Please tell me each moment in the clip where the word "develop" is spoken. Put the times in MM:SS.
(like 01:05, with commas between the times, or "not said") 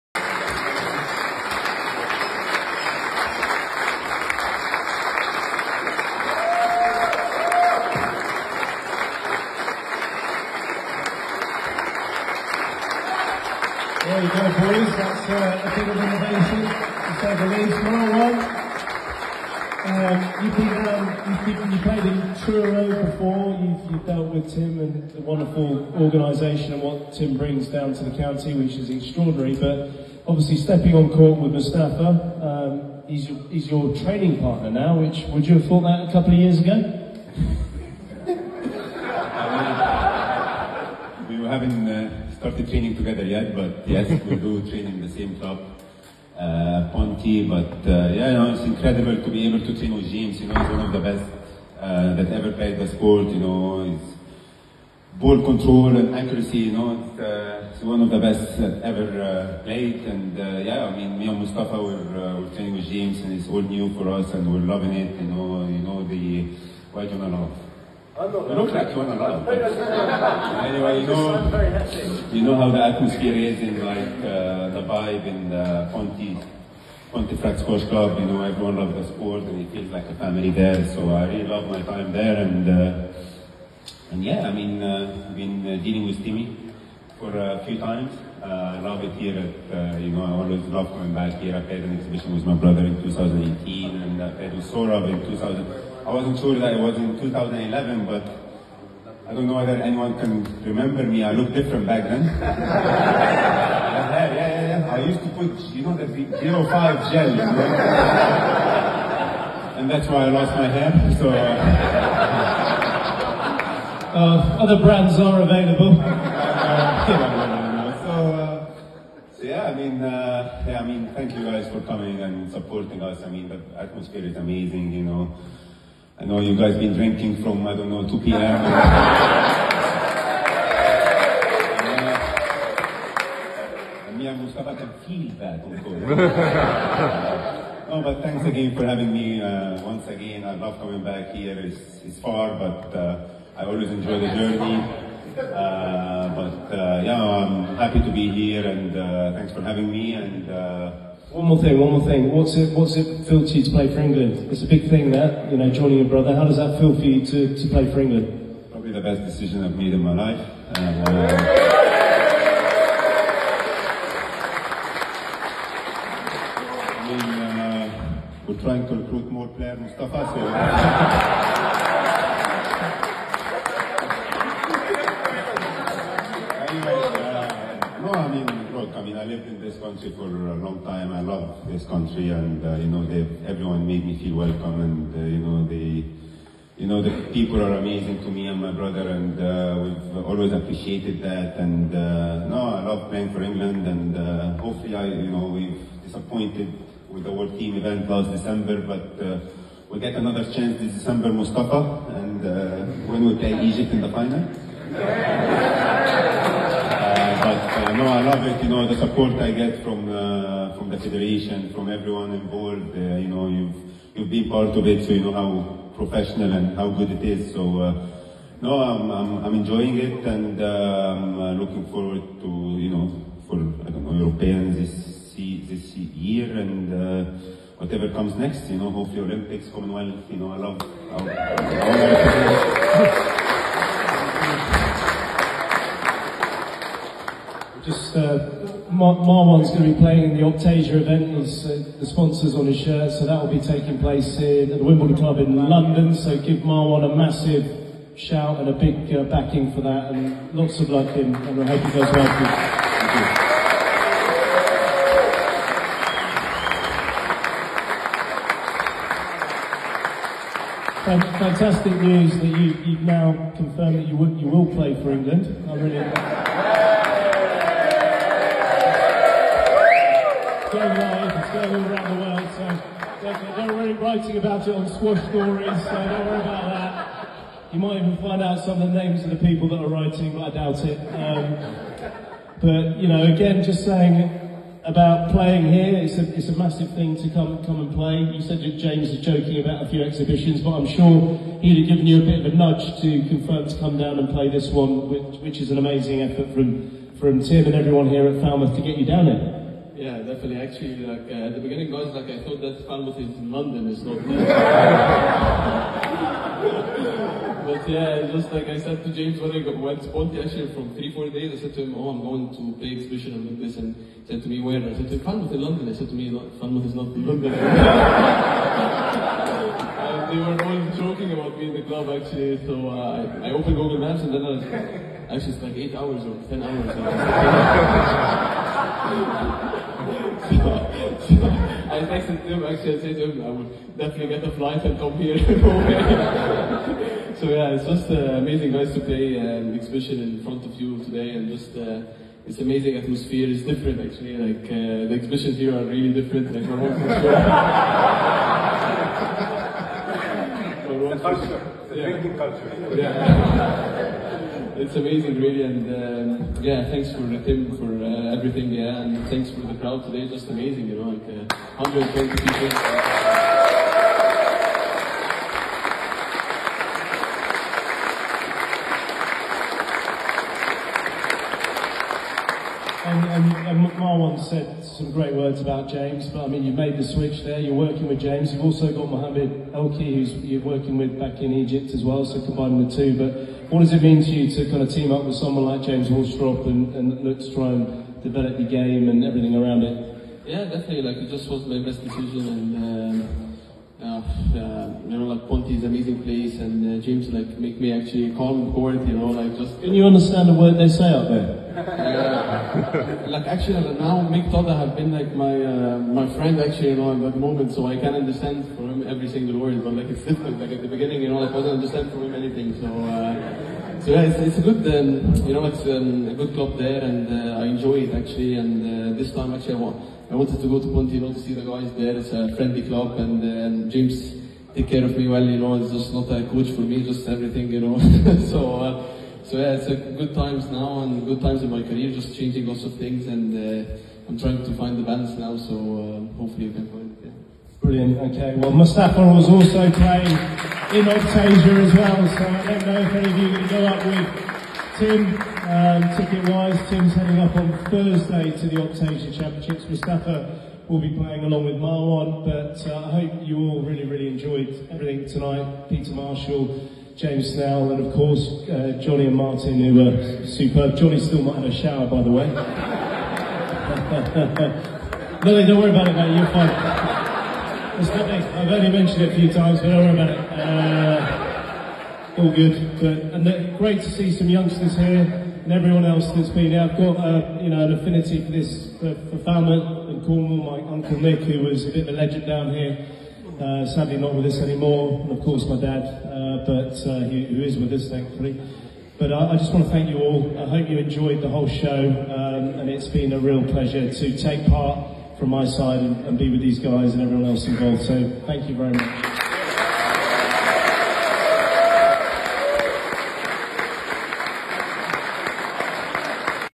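06:28.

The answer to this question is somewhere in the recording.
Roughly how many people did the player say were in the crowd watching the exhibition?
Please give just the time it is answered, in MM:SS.
06:01.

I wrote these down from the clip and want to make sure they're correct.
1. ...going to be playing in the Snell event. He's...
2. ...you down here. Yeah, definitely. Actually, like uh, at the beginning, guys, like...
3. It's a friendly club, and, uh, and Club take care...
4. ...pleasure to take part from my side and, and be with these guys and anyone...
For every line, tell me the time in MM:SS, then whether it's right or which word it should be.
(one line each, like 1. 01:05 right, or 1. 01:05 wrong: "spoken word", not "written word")
1. 03:59 wrong: "Optasia", not "Snell"
2. 04:58 right
3. 07:02 wrong: "James", not "Club"
4. 08:13 wrong: "everyone", not "anyone".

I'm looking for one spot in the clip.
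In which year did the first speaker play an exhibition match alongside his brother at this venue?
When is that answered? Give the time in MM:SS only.
01:33.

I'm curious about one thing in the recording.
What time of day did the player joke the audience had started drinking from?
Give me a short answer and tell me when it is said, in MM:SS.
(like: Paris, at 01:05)
2 p.m., at 02:08.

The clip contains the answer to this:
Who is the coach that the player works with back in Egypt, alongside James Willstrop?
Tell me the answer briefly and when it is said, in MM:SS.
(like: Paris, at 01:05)
Mohamed Elki, at 06:19.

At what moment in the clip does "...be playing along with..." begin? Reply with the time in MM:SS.
07:31.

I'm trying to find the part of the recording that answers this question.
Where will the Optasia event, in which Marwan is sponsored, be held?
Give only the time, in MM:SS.
04:04.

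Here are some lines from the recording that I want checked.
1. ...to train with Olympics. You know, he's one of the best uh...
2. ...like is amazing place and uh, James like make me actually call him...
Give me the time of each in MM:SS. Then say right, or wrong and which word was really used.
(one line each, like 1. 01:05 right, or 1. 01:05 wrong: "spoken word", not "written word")
1. 00:49 wrong: "James", not "Olympics"
2. 06:35 right.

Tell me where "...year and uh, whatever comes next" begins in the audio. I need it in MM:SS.
03:46.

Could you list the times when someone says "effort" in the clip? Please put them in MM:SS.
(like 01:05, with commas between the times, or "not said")
04:56.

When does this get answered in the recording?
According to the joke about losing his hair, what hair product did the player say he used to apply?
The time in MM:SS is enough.
01:46.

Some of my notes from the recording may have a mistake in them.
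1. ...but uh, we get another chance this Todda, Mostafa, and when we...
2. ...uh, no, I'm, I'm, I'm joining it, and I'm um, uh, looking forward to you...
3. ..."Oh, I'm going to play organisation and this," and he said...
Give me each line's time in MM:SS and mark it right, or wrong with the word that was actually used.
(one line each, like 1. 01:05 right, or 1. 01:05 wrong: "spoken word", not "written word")
1. 03:18 wrong: "December", not "Todda"
2. 03:37 wrong: "enjoying", not "joining"
3. 05:11 wrong: "exhibition", not "organisation".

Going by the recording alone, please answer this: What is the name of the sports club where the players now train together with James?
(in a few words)
Pontefract Sports Club.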